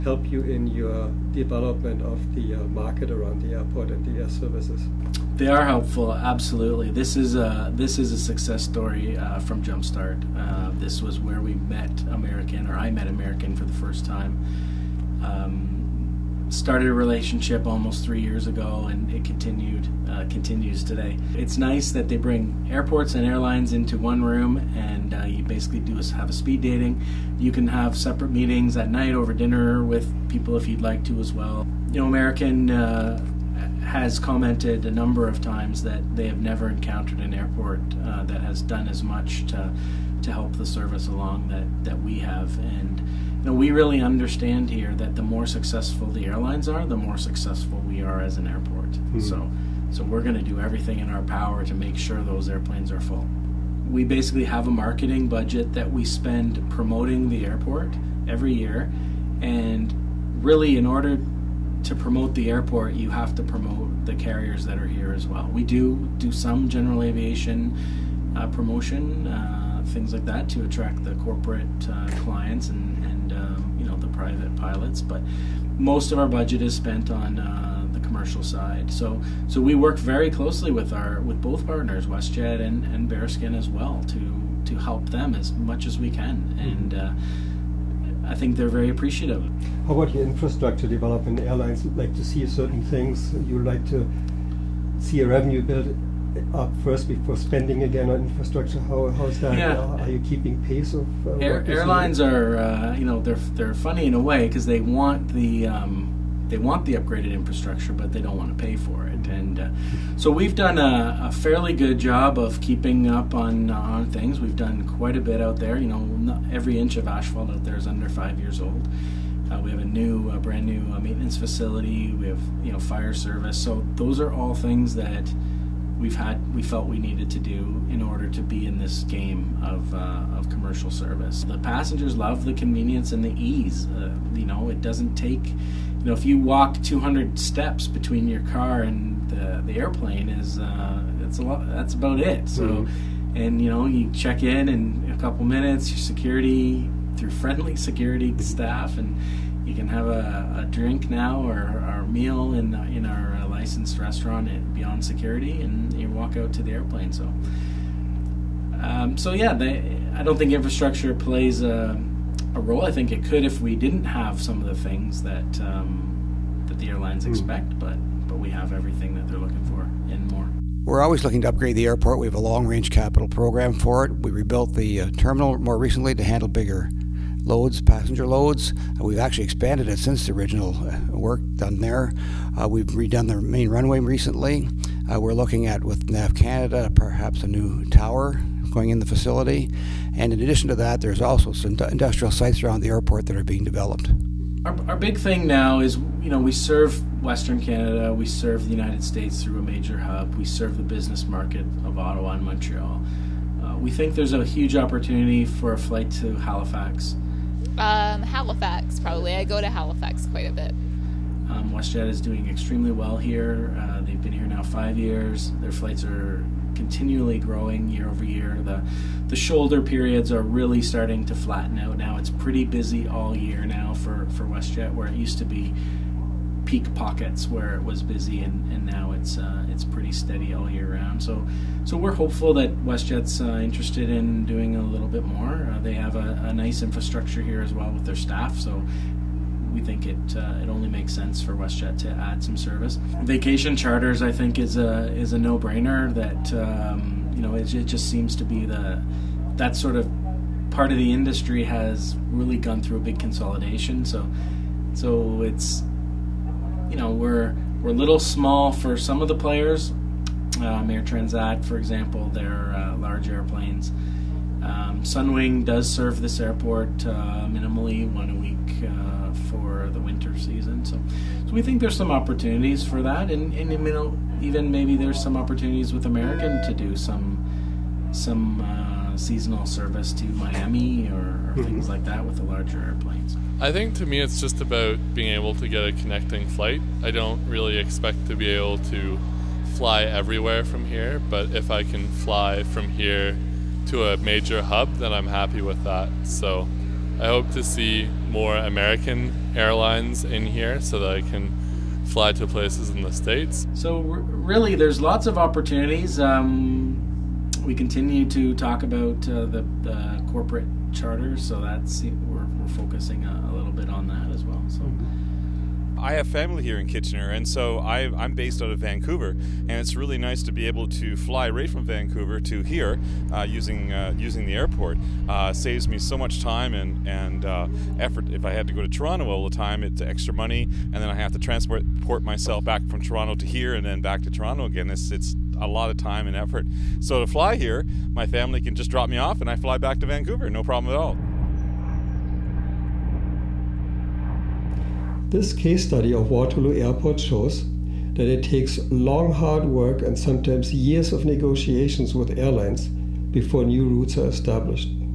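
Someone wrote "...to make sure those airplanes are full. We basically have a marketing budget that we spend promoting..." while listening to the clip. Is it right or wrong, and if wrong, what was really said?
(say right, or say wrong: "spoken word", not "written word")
right.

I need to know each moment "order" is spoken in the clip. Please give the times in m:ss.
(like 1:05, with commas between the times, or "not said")
1:00, 2:08.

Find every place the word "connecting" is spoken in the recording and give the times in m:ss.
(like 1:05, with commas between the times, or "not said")
4:45.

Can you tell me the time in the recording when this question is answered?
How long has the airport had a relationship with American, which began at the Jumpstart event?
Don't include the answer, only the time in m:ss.
0:17.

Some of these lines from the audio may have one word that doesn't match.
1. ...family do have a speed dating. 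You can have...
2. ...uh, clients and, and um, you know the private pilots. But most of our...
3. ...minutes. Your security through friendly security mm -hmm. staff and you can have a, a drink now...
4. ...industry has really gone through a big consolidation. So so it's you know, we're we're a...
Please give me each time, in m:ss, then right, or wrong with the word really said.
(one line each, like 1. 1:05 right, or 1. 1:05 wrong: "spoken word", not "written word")
1. 0:25 wrong: "basically", not "family"
2. 1:11 right
3. 2:25 right
4. 4:11 right.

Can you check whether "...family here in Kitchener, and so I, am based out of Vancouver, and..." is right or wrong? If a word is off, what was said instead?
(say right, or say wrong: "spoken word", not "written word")
right.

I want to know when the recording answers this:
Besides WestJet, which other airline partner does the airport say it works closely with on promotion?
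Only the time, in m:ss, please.
1:23.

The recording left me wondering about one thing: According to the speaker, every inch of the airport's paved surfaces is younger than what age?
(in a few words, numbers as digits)
5 years.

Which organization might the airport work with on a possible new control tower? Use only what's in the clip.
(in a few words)
NAV Canada.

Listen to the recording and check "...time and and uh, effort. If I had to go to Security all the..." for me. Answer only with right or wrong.
wrong.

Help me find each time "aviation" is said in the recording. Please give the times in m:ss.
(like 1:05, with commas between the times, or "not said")
1:07.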